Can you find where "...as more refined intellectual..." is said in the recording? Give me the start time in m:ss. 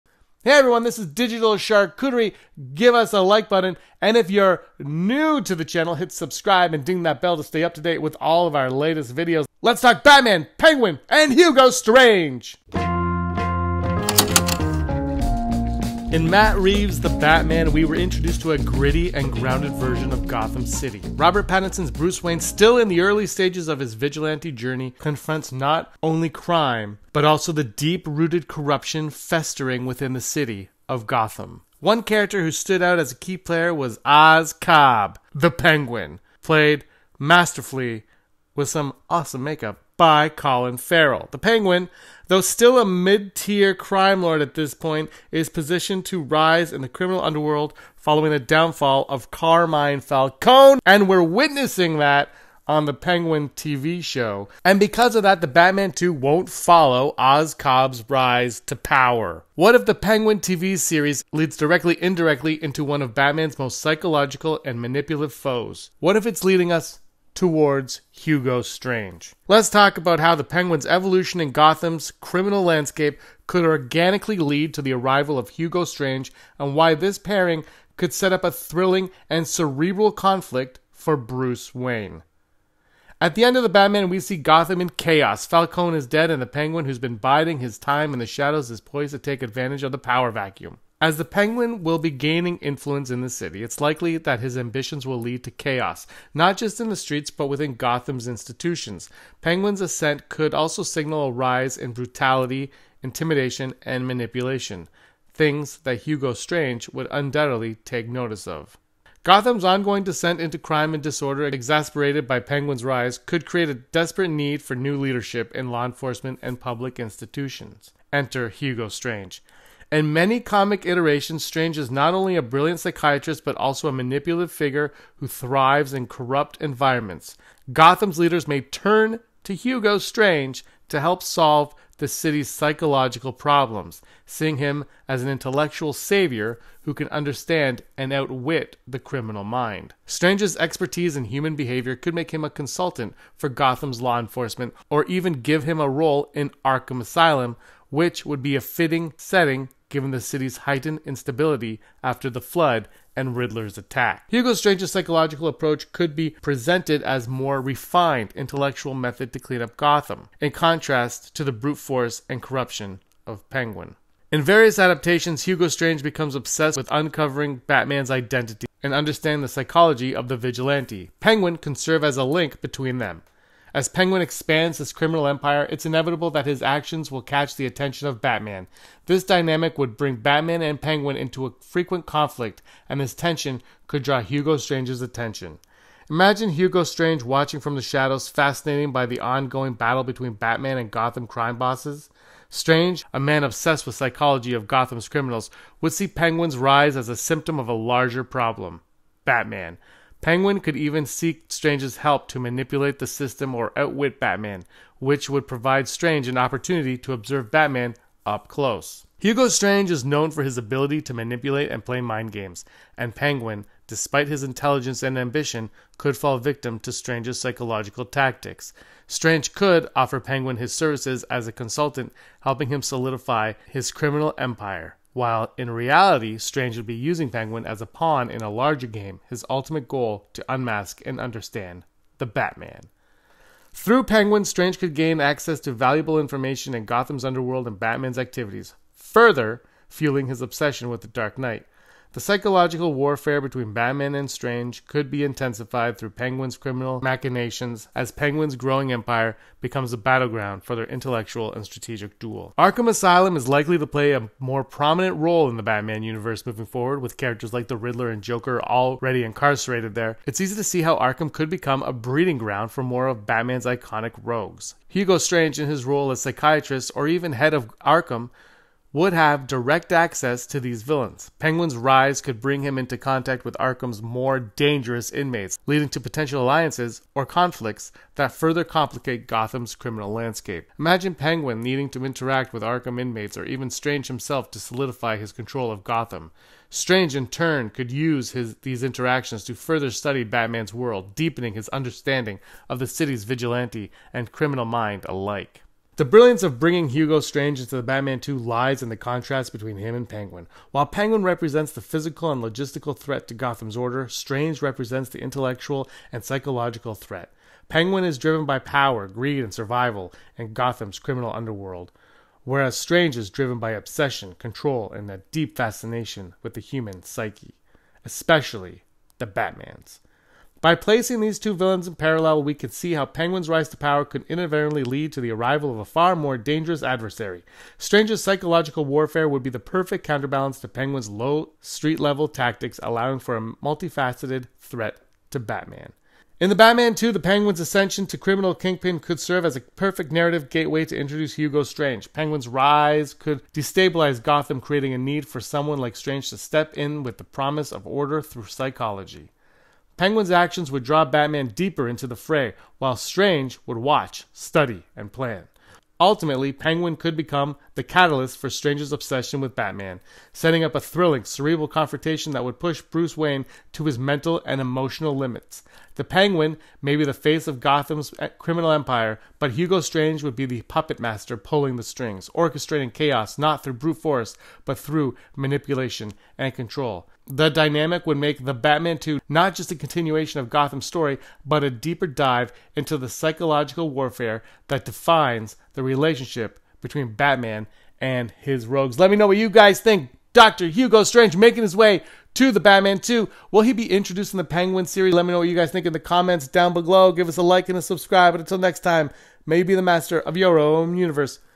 2:37.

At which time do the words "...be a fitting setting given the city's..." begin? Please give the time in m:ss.
2:28.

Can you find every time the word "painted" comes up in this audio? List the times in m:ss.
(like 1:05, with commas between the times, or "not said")
not said.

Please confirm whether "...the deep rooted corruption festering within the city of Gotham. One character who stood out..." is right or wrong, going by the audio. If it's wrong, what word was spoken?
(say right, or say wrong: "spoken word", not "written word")
right.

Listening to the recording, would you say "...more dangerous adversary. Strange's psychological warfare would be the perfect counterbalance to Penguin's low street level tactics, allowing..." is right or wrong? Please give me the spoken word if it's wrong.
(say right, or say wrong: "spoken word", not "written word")
right.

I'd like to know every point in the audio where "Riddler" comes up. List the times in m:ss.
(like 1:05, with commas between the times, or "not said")
2:33, 4:17.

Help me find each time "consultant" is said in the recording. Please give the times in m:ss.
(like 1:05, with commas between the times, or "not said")
2:22, 3:41.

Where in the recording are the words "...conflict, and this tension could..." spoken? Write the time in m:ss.
3:02.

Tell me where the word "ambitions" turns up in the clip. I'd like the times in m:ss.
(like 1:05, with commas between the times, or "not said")
1:34, 3:35.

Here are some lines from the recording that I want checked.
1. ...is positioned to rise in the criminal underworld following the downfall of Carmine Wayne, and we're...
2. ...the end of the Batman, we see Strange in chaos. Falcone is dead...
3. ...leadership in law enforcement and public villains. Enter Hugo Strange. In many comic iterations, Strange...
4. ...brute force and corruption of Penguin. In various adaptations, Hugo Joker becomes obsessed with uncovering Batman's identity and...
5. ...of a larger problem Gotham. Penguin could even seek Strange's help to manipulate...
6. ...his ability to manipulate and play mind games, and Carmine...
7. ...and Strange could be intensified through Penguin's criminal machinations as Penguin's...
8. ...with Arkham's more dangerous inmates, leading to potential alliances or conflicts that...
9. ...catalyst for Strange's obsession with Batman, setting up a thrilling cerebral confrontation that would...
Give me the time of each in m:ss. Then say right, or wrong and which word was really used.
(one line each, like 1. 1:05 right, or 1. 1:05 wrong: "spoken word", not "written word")
1. 0:45 wrong: "Falcone", not "Wayne"
2. 1:23 wrong: "Gotham", not "Strange"
3. 1:54 wrong: "institutions", not "villains"
4. 2:41 wrong: "Strange", not "Joker"
5. 3:17 wrong: "Batman", not "Gotham"
6. 3:30 wrong: "Penguin", not "Carmine"
7. 4:04 right
8. 4:33 right
9. 5:57 right.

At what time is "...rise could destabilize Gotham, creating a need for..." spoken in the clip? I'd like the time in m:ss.
5:42.